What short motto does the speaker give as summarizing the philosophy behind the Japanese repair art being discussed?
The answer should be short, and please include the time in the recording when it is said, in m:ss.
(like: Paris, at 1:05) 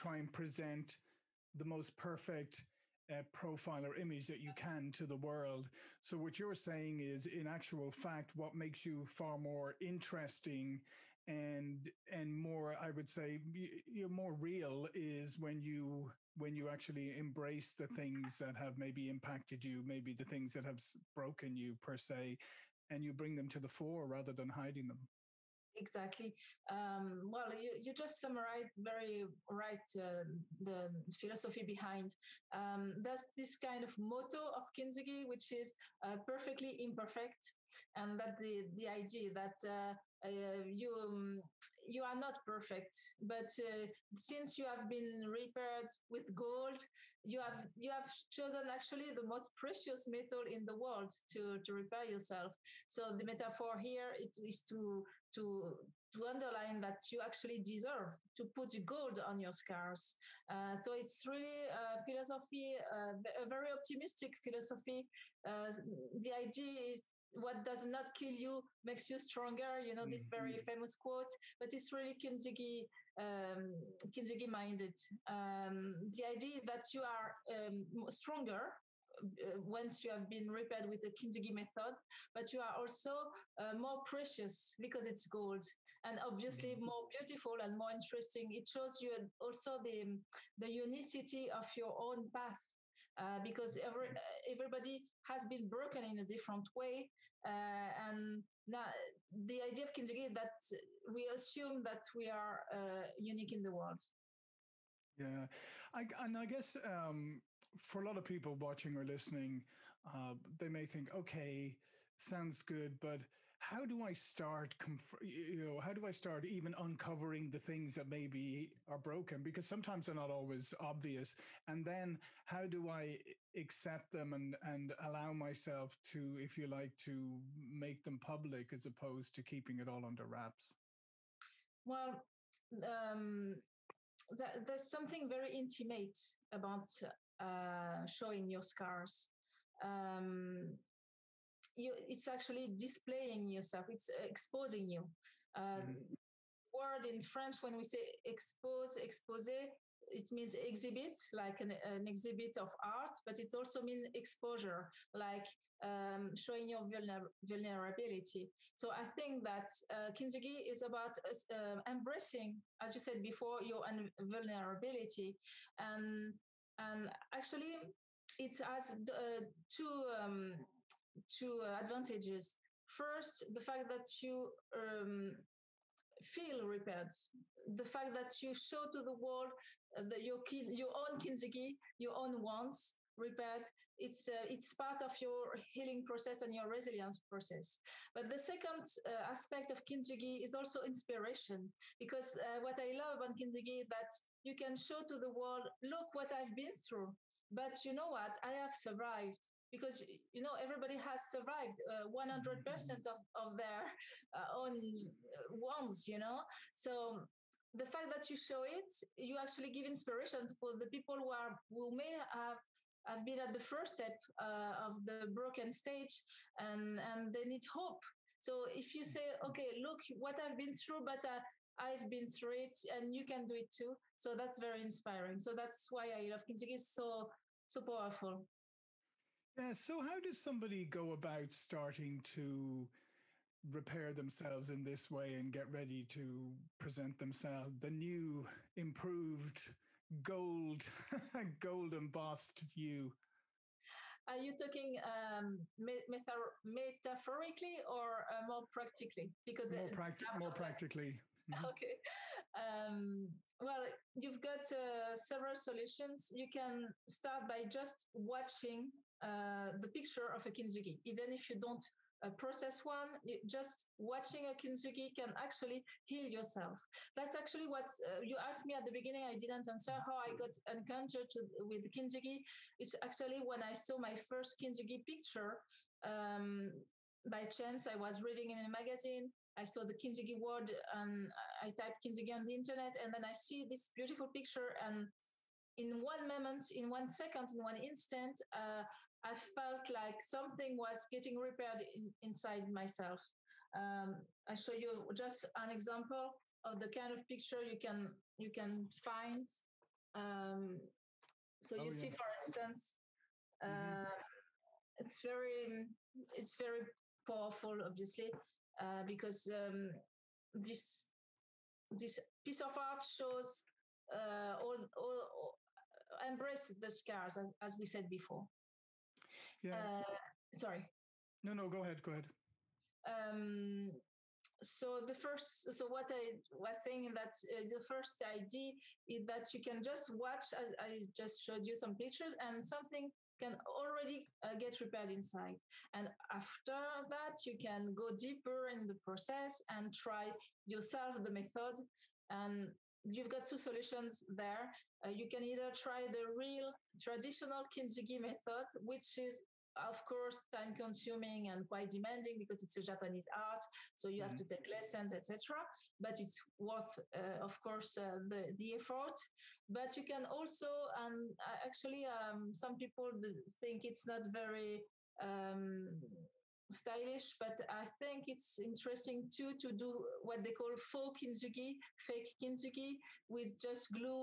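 perfectly imperfect, at 0:36.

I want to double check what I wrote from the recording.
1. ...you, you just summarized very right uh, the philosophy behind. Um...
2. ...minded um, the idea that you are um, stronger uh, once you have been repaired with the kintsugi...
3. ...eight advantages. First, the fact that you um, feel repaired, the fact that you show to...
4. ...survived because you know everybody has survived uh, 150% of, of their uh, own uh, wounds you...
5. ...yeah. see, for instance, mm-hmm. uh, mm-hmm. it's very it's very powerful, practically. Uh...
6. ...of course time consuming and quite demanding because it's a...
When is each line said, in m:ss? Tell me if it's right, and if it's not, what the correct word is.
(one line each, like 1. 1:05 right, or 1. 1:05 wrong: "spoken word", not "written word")
1. 0:27 right
2. 1:14 right
3. 2:51 wrong: "two", not "eight"
4. 3:18 wrong: "100", not "150"
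5. 5:01 wrong: "obviously", not "practically"
6. 5:49 right.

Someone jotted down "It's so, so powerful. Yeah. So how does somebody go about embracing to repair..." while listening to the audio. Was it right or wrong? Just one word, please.
wrong.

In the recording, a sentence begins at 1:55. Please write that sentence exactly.
you know, how do I start even uncovering the things that maybe are broken?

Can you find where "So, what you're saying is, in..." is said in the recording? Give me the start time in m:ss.
0:05.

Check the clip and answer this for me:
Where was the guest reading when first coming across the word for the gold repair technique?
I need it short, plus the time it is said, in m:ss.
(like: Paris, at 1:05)
a magazine, at 4:38.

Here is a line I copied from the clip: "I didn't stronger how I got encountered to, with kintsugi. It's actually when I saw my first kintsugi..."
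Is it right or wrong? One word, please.
wrong.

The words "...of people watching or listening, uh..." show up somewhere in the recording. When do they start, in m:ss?
1:48.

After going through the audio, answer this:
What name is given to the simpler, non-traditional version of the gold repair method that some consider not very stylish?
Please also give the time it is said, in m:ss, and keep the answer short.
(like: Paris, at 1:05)
faux kintsugi, at 6:10.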